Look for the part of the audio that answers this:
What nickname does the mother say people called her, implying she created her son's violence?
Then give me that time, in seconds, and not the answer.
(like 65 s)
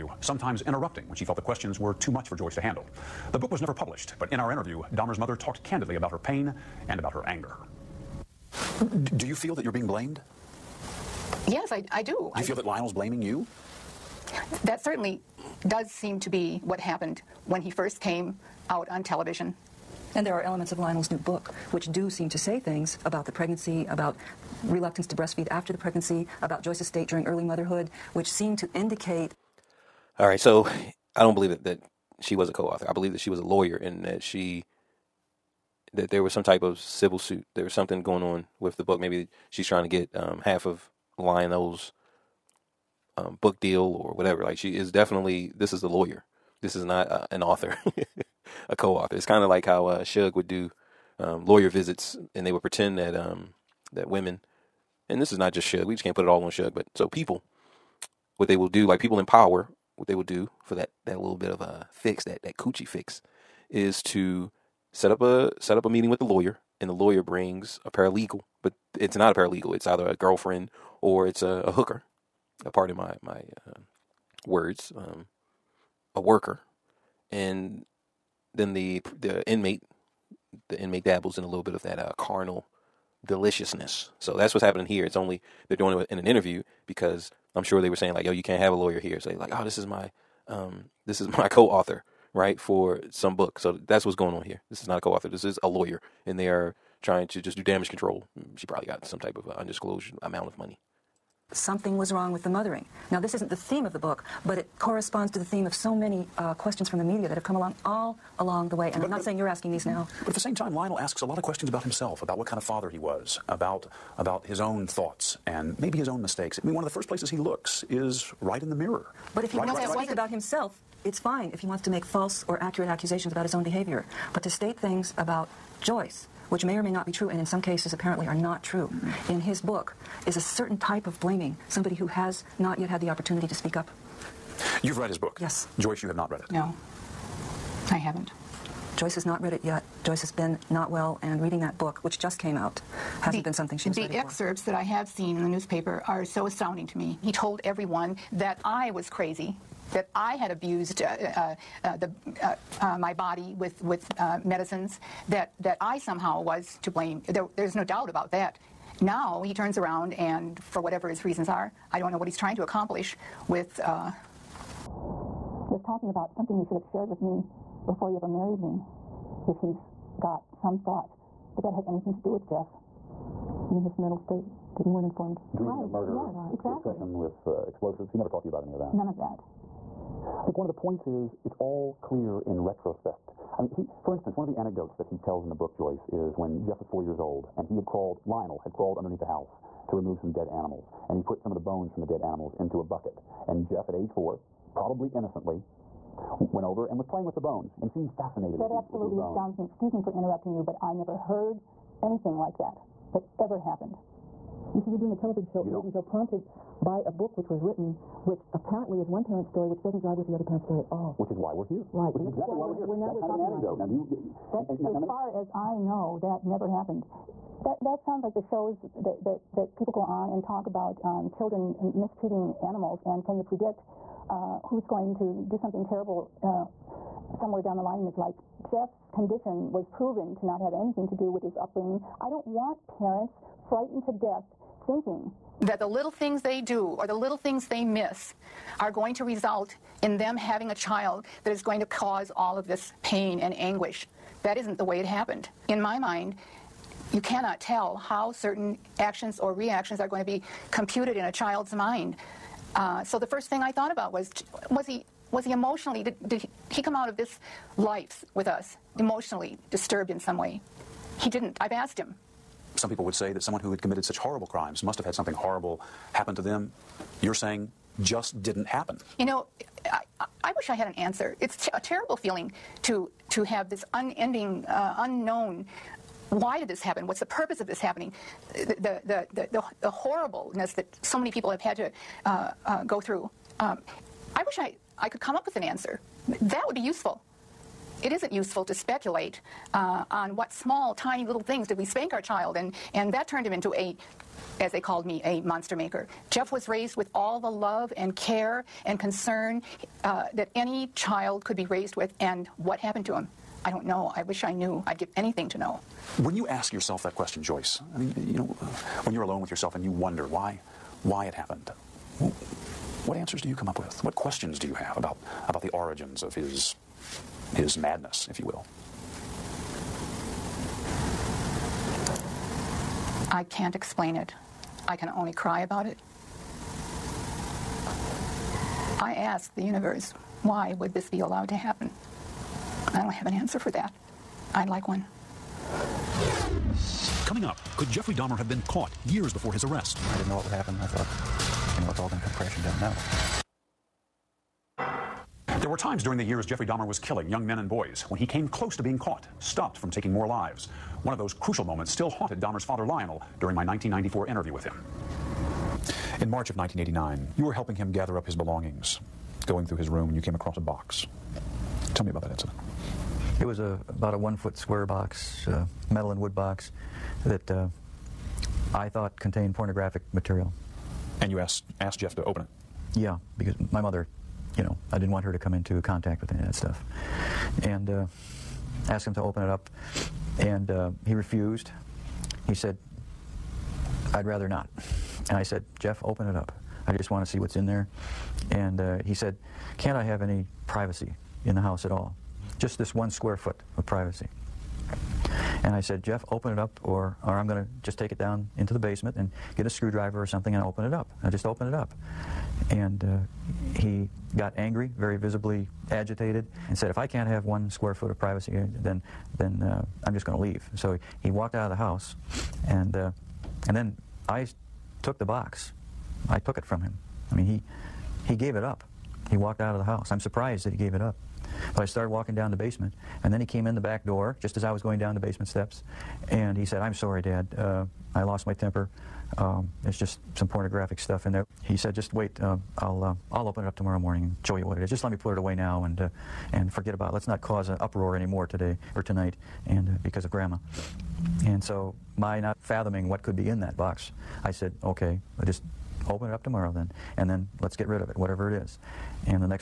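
295 s.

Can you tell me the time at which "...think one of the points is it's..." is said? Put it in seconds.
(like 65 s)
180 s.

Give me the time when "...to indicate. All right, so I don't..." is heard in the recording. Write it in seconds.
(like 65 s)
28 s.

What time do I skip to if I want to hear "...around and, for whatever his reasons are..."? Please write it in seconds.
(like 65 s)
159 s.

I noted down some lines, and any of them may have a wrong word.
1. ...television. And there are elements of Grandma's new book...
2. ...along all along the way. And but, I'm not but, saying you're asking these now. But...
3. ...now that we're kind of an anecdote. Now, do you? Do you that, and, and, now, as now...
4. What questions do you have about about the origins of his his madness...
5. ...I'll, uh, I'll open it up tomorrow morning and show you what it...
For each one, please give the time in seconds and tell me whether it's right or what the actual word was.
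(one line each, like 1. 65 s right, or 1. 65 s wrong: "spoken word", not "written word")
1. 19 s wrong: "Lionel", not "Grandma"
2. 107 s right
3. 212 s right
4. 314 s right
5. 432 s right.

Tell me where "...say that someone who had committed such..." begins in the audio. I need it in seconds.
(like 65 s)
263 s.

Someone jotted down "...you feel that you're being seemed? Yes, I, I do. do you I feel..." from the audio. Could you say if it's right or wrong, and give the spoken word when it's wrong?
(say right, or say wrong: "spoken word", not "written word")
wrong: "blamed", not "seemed".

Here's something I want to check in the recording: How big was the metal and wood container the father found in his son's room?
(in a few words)
1 foot square.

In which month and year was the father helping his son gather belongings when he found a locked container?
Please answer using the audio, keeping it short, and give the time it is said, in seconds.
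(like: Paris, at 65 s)
March 1989, at 356 s.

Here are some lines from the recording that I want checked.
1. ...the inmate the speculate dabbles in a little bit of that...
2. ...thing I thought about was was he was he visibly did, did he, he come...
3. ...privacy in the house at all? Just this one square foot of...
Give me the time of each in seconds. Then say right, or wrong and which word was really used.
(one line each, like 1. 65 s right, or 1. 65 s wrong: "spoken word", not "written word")
1. 79 s wrong: "inmate", not "speculate"
2. 253 s wrong: "emotionally", not "visibly"
3. 390 s right.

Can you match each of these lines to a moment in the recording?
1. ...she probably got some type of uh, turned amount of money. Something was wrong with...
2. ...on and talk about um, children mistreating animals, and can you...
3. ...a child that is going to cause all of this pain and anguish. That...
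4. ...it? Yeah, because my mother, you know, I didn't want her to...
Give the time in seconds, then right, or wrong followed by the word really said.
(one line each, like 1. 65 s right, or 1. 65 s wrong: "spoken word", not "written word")
1. 98 s wrong: "undisclosed", not "turned"
2. 220 s right
3. 240 s right
4. 372 s right.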